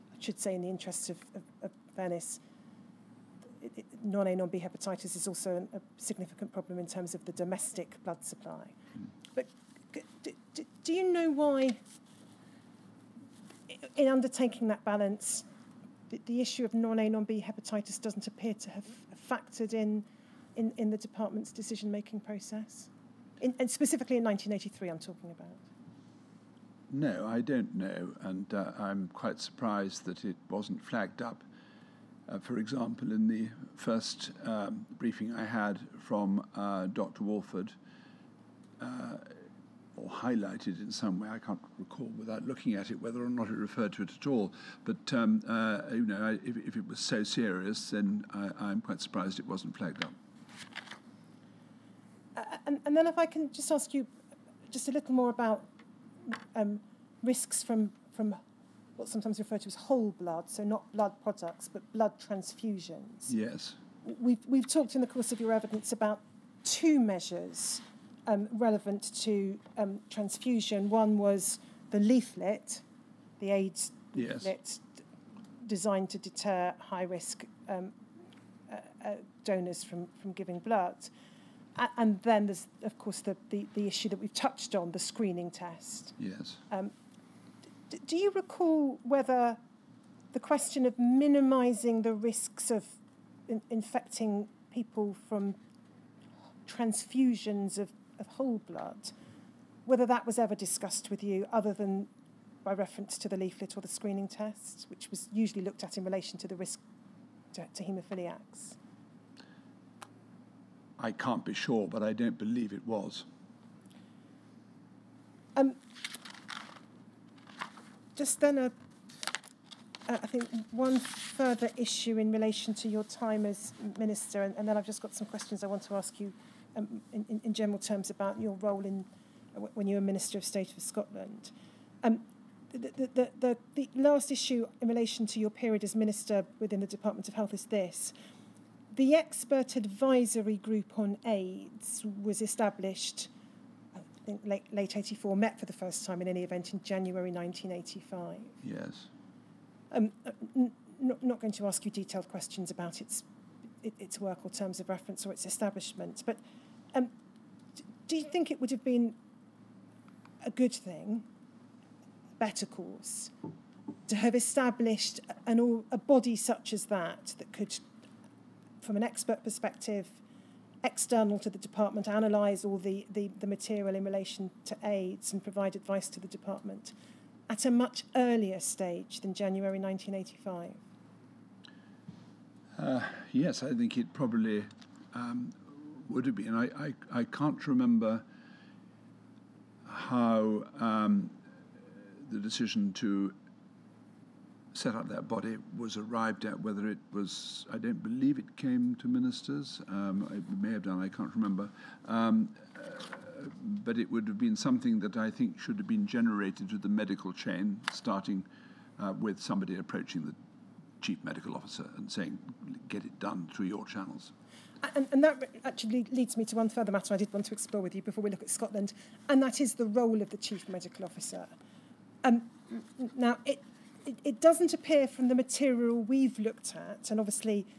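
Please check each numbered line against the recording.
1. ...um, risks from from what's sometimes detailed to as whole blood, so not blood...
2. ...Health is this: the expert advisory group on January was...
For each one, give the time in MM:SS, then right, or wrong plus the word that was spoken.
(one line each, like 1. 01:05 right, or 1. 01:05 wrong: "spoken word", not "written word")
1. 00:56 wrong: "referred", not "detailed"
2. 02:17 wrong: "AIDS", not "January".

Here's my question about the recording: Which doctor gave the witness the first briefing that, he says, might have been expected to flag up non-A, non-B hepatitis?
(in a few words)
Dr. Walford.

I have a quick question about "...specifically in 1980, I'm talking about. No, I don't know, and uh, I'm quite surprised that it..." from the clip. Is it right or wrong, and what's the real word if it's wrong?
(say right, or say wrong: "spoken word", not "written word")
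wrong: "1983", not "1980".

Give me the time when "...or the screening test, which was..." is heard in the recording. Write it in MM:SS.
01:43.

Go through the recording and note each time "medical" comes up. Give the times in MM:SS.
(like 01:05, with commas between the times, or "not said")
03:26, 03:31, 03:40.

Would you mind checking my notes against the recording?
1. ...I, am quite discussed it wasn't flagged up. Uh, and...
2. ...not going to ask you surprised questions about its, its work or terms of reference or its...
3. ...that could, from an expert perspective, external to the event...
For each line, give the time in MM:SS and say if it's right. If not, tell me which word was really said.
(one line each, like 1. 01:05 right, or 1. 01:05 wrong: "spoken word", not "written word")
1. 00:48 wrong: "surprised", not "discussed"
2. 02:31 wrong: "detailed", not "surprised"
3. 02:47 wrong: "department", not "event".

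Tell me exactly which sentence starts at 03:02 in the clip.
Uh, yes, I think it probably um, would have been.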